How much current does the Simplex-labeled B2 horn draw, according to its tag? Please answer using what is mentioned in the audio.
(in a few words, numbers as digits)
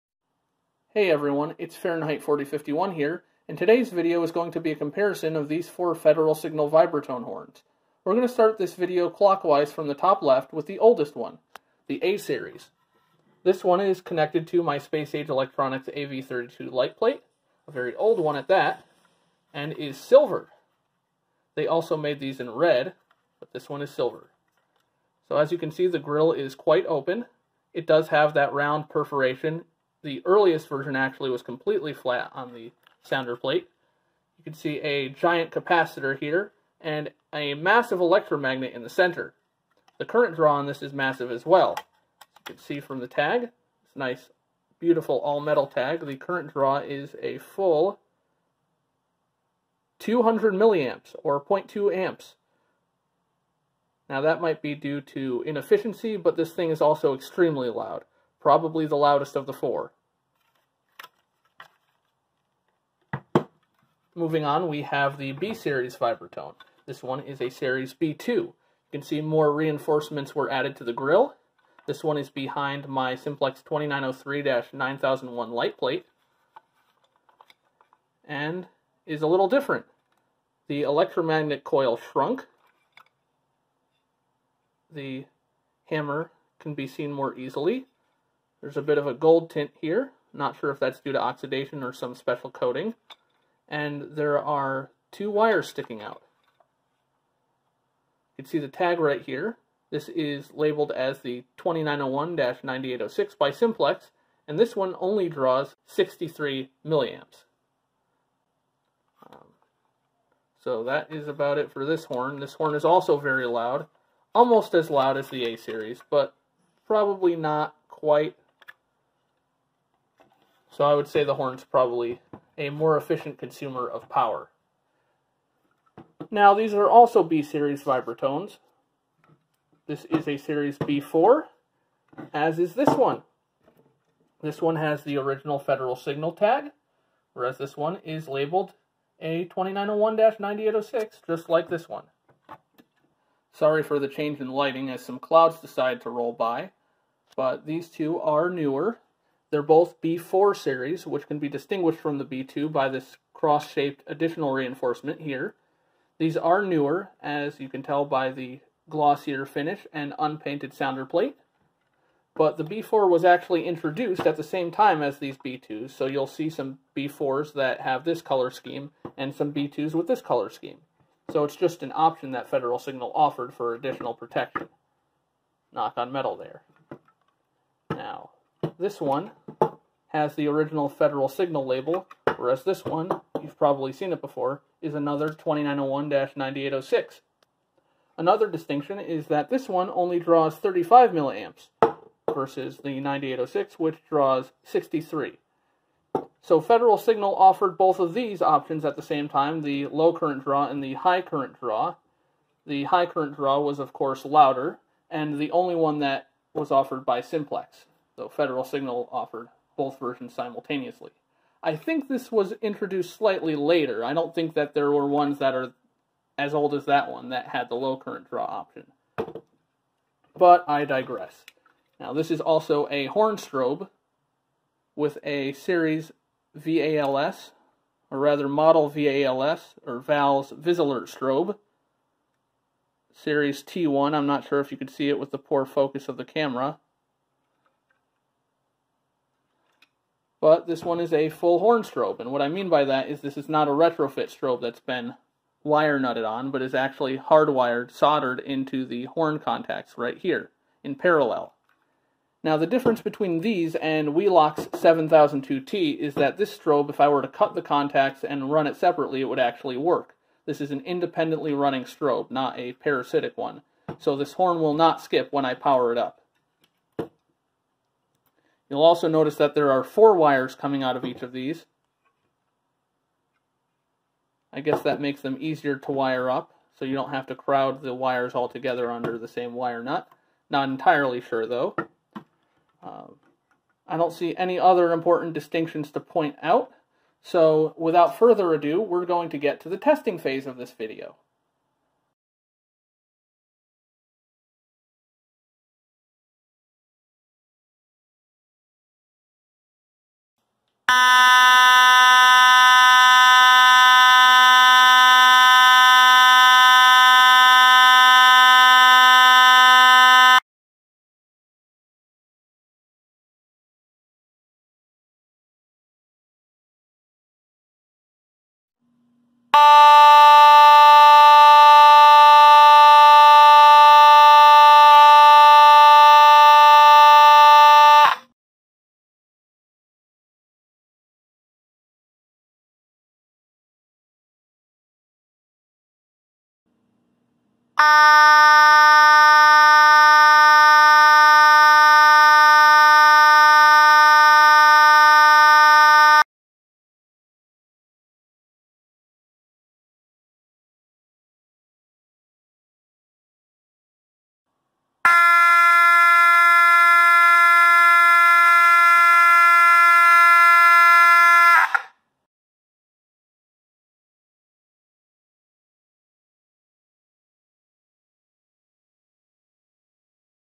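63 milliamps.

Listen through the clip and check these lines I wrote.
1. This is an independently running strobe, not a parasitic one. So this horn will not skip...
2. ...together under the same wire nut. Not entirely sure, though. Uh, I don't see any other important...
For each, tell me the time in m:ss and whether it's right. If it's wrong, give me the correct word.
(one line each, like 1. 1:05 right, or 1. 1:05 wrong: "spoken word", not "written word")
1. 4:20 right
2. 4:38 right.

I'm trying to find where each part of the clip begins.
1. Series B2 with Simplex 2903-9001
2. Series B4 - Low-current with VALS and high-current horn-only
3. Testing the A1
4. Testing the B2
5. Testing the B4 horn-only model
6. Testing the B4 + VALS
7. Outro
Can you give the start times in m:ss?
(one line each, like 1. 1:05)
1. 1:04
2. 2:06
3. 4:52
4. 5:11
5. 5:29
6. 5:47
7. 6:03.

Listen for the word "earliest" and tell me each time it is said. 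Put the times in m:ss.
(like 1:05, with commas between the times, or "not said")
0:30.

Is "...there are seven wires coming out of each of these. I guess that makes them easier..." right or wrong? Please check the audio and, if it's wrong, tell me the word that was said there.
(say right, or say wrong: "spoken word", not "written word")
wrong: "four", not "seven".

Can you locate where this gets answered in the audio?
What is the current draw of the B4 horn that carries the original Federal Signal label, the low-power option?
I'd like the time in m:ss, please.
3:10.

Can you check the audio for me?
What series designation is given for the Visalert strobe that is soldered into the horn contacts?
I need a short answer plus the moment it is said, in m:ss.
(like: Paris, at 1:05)
T1, at 3:53.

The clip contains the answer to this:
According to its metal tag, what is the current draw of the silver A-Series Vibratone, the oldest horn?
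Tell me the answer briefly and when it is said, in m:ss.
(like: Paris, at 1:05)
200 milliamps, at 0:49.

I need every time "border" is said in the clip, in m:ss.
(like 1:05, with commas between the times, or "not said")
not said.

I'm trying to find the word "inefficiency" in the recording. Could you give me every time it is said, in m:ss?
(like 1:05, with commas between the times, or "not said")
0:55.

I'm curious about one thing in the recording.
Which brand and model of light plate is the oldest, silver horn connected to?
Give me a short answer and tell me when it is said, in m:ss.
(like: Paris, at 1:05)
Space Age Electronics AV32, at 0:14.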